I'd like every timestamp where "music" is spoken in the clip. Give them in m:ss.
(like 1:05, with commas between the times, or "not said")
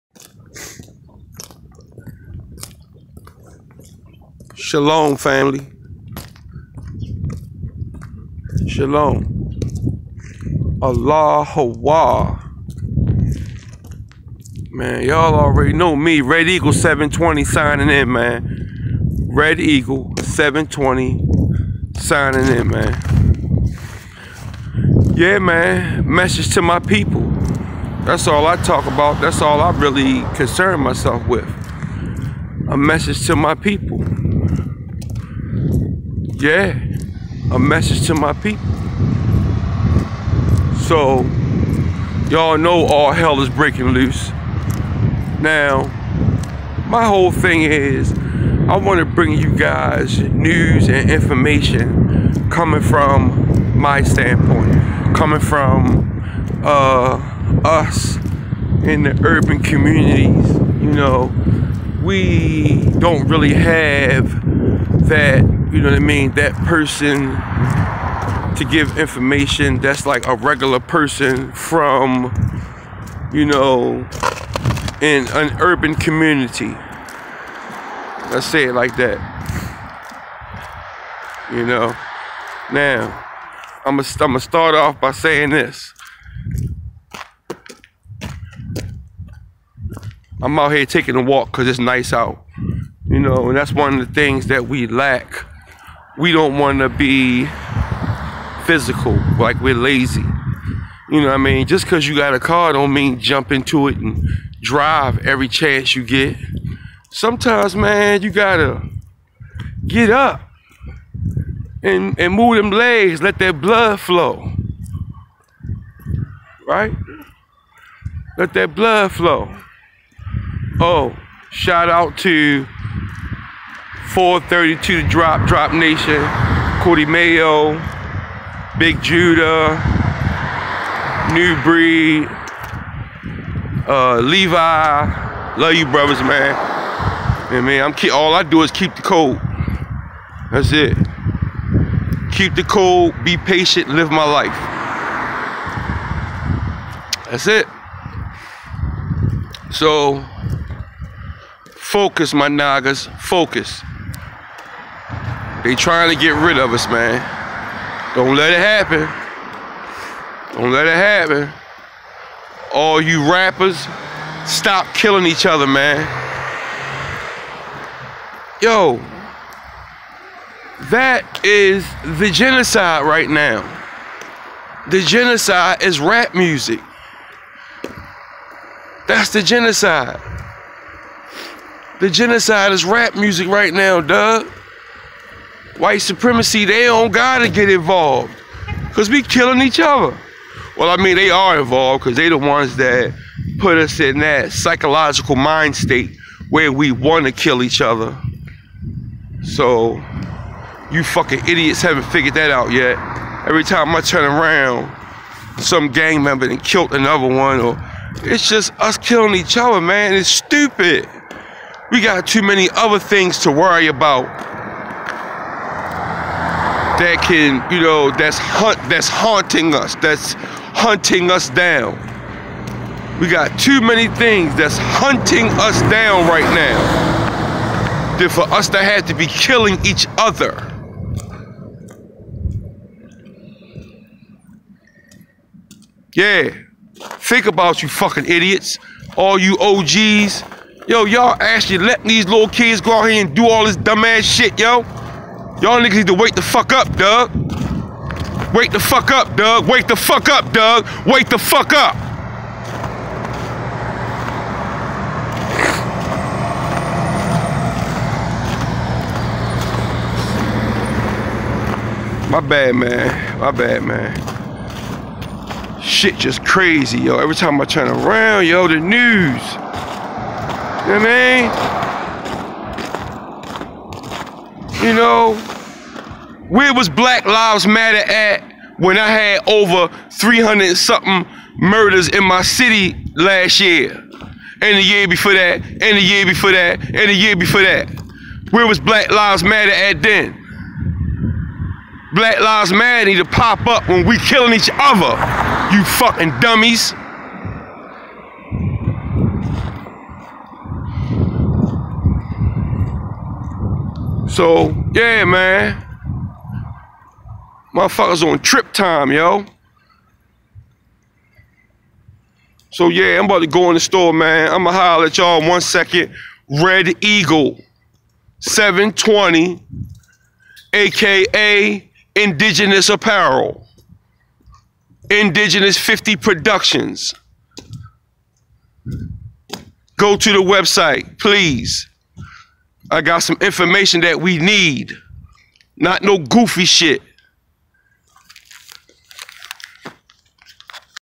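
2:56, 3:03.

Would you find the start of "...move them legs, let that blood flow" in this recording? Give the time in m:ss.
1:52.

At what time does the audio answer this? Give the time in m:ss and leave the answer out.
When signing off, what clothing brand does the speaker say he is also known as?
5:22.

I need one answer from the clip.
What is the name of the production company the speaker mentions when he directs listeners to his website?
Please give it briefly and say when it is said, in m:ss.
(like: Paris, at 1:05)
Indigenous 50 Productions, at 5:25.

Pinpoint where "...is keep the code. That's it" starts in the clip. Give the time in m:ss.
2:18.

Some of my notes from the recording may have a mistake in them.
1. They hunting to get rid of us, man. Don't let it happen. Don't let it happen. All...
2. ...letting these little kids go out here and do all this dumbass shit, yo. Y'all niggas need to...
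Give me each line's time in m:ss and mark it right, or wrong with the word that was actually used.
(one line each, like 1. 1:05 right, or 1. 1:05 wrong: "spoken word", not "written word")
1. 2:35 wrong: "trying", not "hunting"
2. 4:01 right.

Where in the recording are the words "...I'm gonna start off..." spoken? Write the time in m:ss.
1:24.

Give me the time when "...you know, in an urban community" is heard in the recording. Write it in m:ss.
1:13.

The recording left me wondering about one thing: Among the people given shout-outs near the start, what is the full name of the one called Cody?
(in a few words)
Cody Mayo.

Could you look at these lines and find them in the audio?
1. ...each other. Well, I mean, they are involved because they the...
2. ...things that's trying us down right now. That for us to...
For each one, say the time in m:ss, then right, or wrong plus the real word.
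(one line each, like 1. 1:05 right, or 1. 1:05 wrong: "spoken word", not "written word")
1. 3:09 right
2. 3:44 wrong: "hunting", not "trying".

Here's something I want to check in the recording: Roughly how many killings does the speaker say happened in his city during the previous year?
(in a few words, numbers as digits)
300.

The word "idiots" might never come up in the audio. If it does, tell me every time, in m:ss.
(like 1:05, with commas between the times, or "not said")
3:21, 3:58.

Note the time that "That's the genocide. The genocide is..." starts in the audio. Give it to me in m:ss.
2:59.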